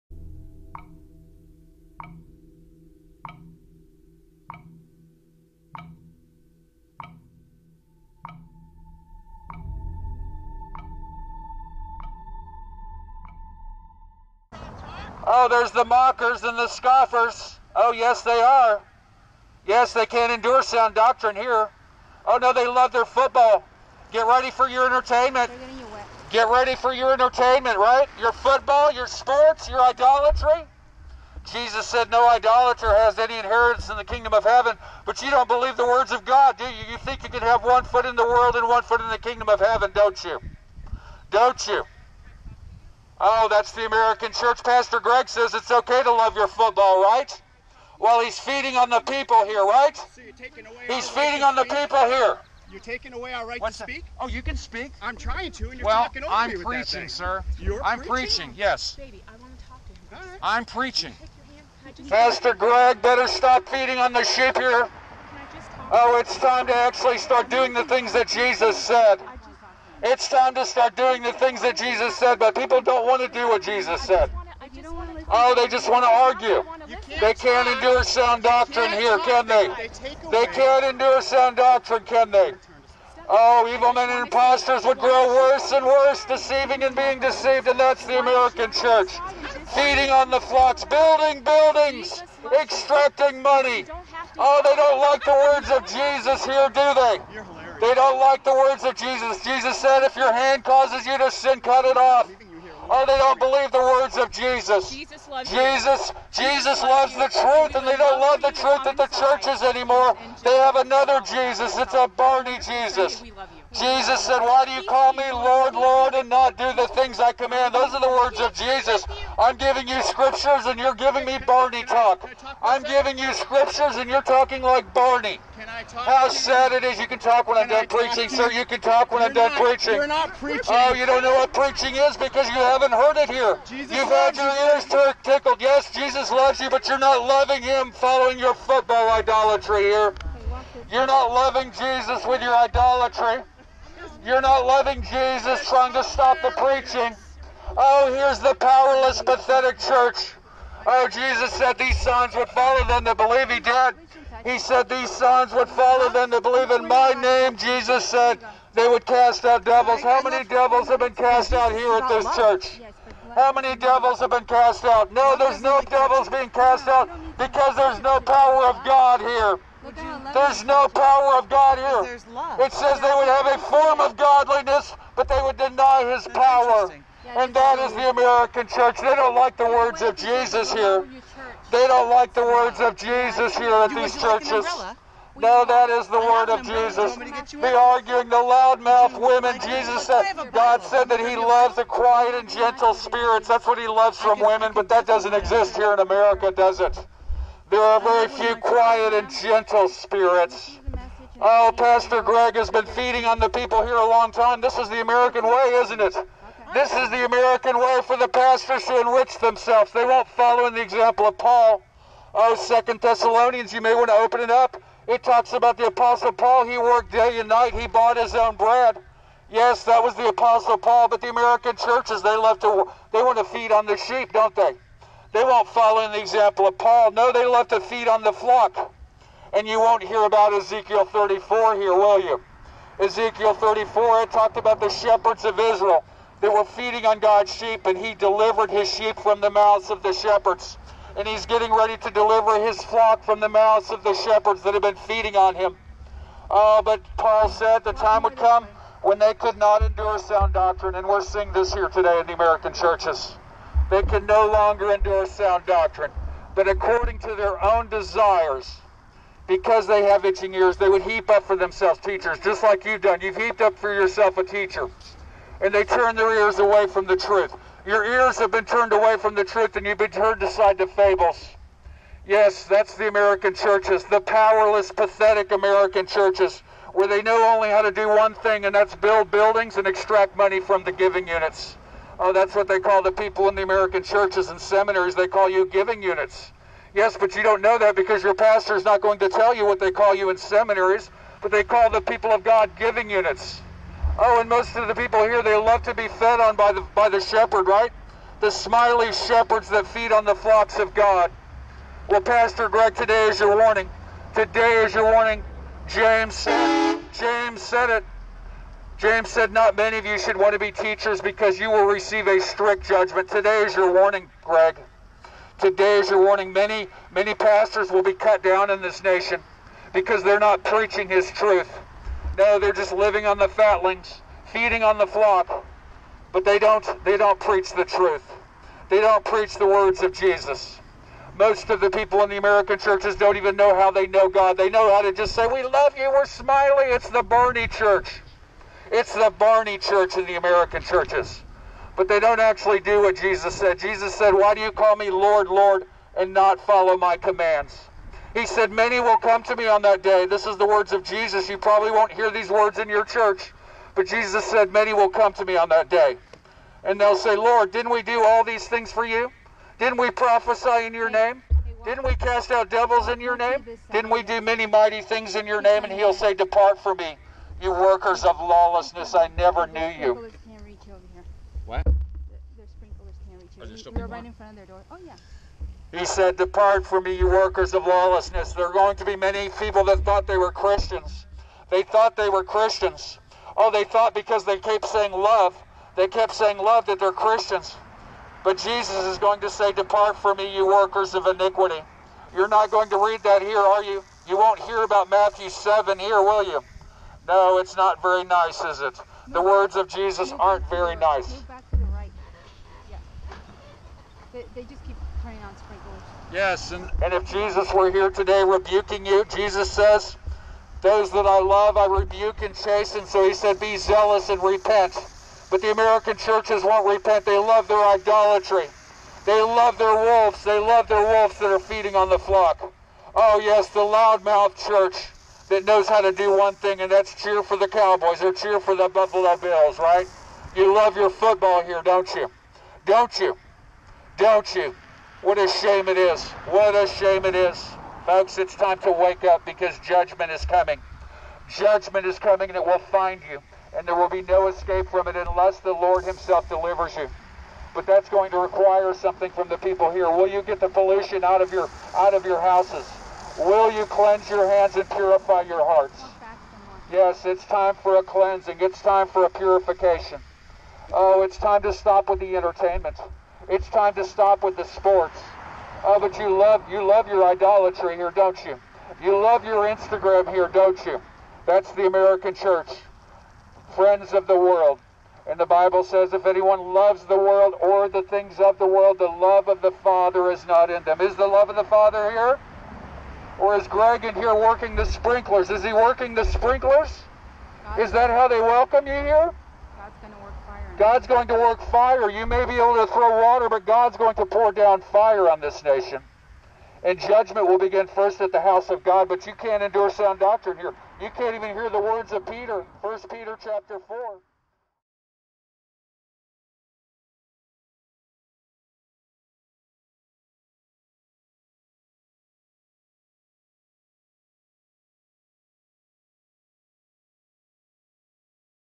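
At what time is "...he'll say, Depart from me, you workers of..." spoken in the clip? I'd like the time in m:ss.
6:05.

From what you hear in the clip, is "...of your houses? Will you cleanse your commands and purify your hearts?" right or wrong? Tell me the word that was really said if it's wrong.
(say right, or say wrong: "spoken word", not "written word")
wrong: "hands", not "commands".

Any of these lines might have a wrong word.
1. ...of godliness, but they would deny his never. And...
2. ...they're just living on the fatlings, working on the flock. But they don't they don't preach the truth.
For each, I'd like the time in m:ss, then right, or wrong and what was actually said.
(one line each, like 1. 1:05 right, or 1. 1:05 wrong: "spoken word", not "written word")
1. 2:54 wrong: "power", not "never"
2. 5:22 wrong: "feeding", not "working".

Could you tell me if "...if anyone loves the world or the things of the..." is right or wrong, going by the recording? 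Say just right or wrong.
right.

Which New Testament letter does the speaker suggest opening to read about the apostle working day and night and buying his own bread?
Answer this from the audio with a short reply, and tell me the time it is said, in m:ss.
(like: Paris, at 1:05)
Second Thessalonians, at 3:32.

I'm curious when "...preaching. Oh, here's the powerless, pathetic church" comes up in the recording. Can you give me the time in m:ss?
2:26.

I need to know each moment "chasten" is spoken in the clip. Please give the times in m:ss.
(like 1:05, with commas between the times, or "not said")
6:52.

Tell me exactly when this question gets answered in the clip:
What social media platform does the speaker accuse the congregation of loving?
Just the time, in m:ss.
7:49.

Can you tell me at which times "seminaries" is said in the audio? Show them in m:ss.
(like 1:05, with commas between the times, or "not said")
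4:44, 4:50.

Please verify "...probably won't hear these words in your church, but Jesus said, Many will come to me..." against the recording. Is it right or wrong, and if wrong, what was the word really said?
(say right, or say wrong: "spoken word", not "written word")
right.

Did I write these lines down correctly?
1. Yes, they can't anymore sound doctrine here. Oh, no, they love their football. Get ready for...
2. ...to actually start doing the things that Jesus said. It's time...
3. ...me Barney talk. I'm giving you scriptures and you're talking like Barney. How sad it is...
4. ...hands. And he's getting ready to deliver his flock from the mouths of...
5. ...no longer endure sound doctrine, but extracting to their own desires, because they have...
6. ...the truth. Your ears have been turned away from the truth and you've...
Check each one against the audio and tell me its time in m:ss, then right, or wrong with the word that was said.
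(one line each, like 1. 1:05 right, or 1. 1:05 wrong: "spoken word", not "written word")
1. 0:19 wrong: "endure", not "anymore"
2. 1:06 right
3. 2:01 right
4. 4:00 wrong: "shepherds", not "hands"
5. 4:14 wrong: "according", not "extracting"
6. 4:27 right.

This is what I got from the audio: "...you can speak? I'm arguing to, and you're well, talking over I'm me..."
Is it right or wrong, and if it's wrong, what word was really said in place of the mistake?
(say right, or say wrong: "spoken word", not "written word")
wrong: "trying", not "arguing".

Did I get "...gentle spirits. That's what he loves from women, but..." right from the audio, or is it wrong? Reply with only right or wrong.
right.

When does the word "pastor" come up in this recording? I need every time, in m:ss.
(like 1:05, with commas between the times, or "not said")
0:44, 1:02, 3:21, 3:28, 4:48, 5:02, 5:17.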